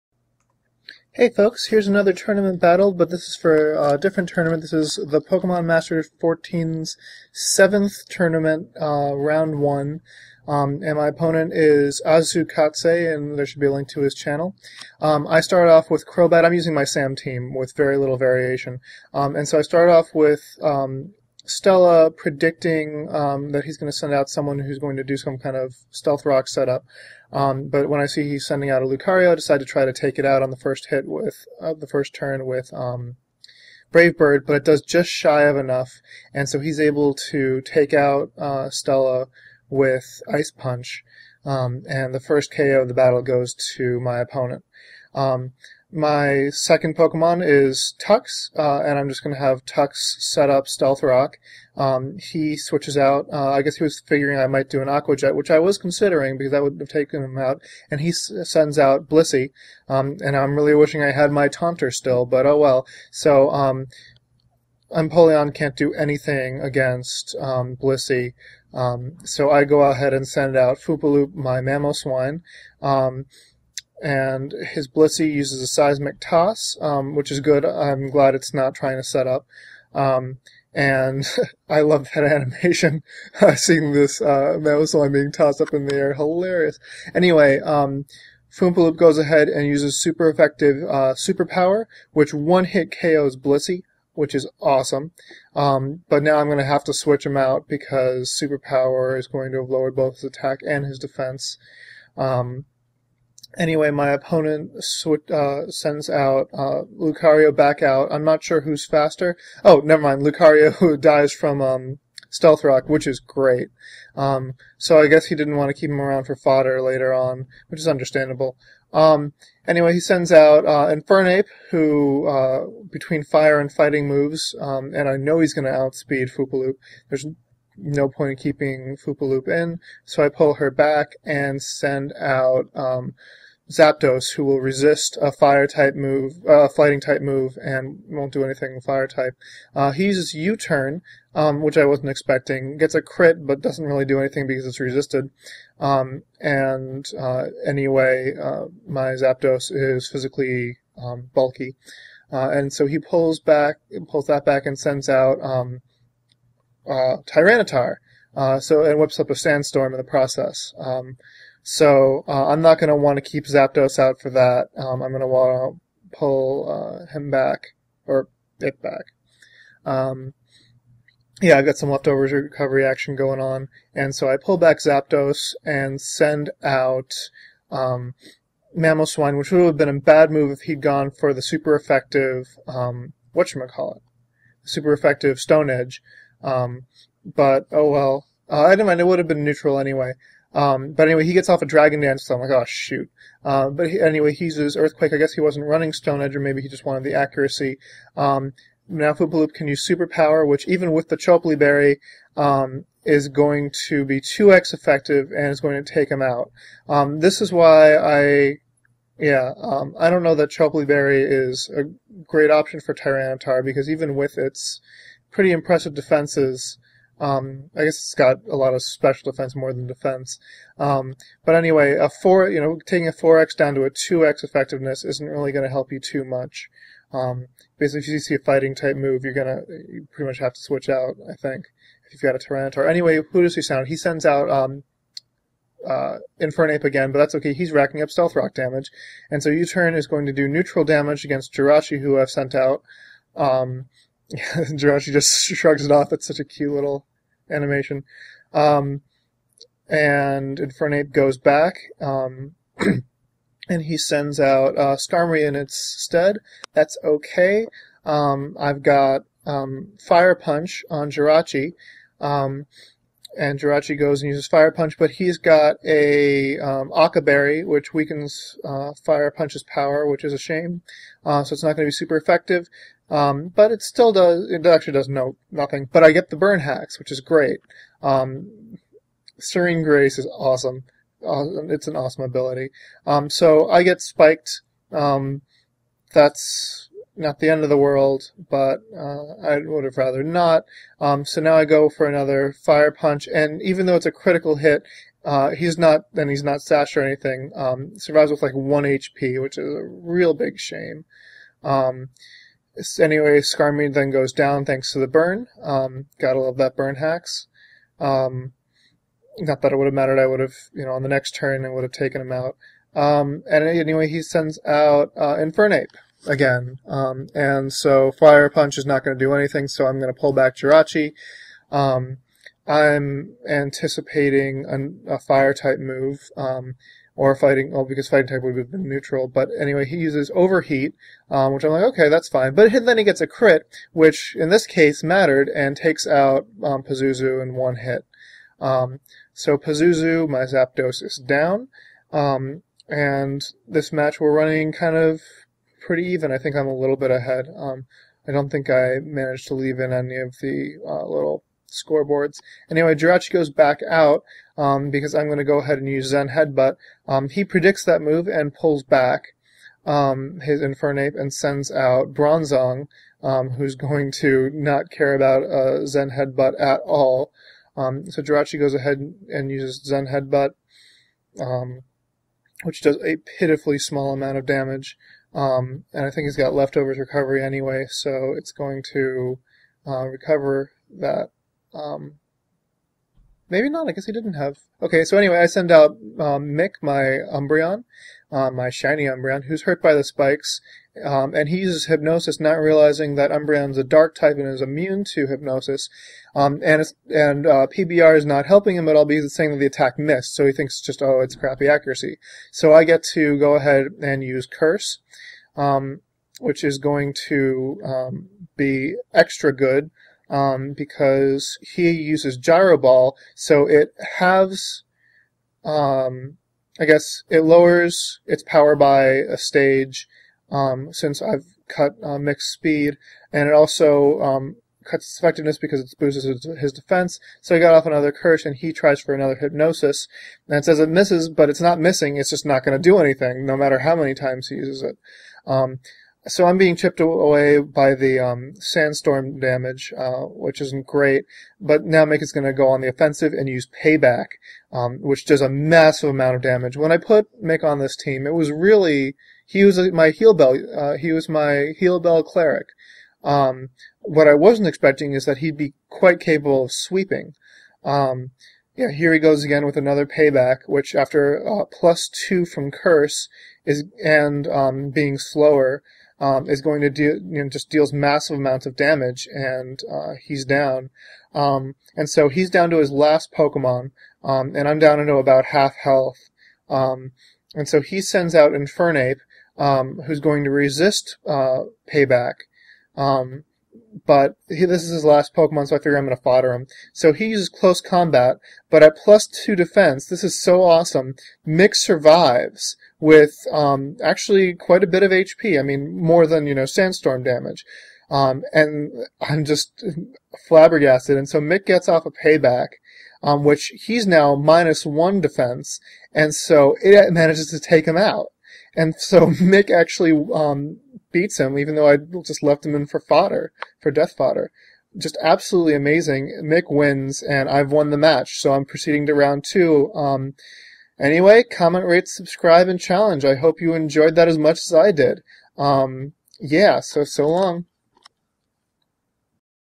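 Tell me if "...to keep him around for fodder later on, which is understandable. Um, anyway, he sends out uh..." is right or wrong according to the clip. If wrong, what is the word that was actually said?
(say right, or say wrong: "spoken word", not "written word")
right.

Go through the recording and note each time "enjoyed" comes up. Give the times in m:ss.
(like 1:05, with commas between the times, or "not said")
8:43.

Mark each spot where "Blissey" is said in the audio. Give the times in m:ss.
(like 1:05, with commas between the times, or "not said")
0:59, 1:07, 1:14, 1:33.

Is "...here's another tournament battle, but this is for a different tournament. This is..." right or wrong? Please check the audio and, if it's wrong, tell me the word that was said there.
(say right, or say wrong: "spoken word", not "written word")
right.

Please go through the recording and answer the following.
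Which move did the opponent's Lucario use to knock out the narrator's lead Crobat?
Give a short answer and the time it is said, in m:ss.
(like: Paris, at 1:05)
Ice Punch, at 0:40.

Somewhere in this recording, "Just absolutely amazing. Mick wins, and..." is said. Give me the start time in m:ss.
8:34.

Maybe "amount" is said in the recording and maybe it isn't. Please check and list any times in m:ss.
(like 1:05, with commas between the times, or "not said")
6:14, 7:26, 7:48.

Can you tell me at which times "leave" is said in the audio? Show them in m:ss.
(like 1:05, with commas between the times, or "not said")
5:49.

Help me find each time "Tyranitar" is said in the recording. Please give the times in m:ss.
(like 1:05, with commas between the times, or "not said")
2:37, 3:32, 3:52.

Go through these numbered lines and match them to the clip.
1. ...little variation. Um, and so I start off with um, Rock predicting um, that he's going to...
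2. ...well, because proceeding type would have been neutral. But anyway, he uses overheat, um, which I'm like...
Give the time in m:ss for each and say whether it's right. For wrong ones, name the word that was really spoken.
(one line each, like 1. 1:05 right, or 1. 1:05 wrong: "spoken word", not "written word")
1. 0:17 wrong: "Stella", not "Rock"
2. 5:27 wrong: "fighting", not "proceeding".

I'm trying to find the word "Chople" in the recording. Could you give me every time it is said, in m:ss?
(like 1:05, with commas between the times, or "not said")
3:21, 3:30.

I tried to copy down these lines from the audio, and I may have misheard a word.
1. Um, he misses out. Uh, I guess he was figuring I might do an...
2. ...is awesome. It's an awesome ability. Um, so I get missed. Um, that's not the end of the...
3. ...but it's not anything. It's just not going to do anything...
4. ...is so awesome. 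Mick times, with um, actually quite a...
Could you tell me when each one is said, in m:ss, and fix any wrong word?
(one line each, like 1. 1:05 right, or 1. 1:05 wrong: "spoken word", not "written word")
1. 0:51 wrong: "switches", not "misses"
2. 4:40 wrong: "spiked", not "missed"
3. 7:11 wrong: "missing", not "anything"
4. 8:10 wrong: "survives", not "times".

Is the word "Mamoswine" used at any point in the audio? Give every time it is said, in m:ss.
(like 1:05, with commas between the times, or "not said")
1:11, 2:58.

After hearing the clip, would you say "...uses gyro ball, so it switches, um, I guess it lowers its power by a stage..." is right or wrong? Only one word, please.
wrong.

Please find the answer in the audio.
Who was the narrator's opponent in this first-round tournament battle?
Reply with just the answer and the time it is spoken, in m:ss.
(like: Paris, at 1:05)
Asukatze, at 0:12.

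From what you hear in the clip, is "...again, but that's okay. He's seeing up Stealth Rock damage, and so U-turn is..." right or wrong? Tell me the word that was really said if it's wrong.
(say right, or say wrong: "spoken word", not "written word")
wrong: "racking", not "seeing".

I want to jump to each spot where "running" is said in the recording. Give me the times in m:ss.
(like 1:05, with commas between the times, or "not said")
3:15, 5:44.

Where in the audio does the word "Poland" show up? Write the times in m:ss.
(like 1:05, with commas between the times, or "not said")
not said.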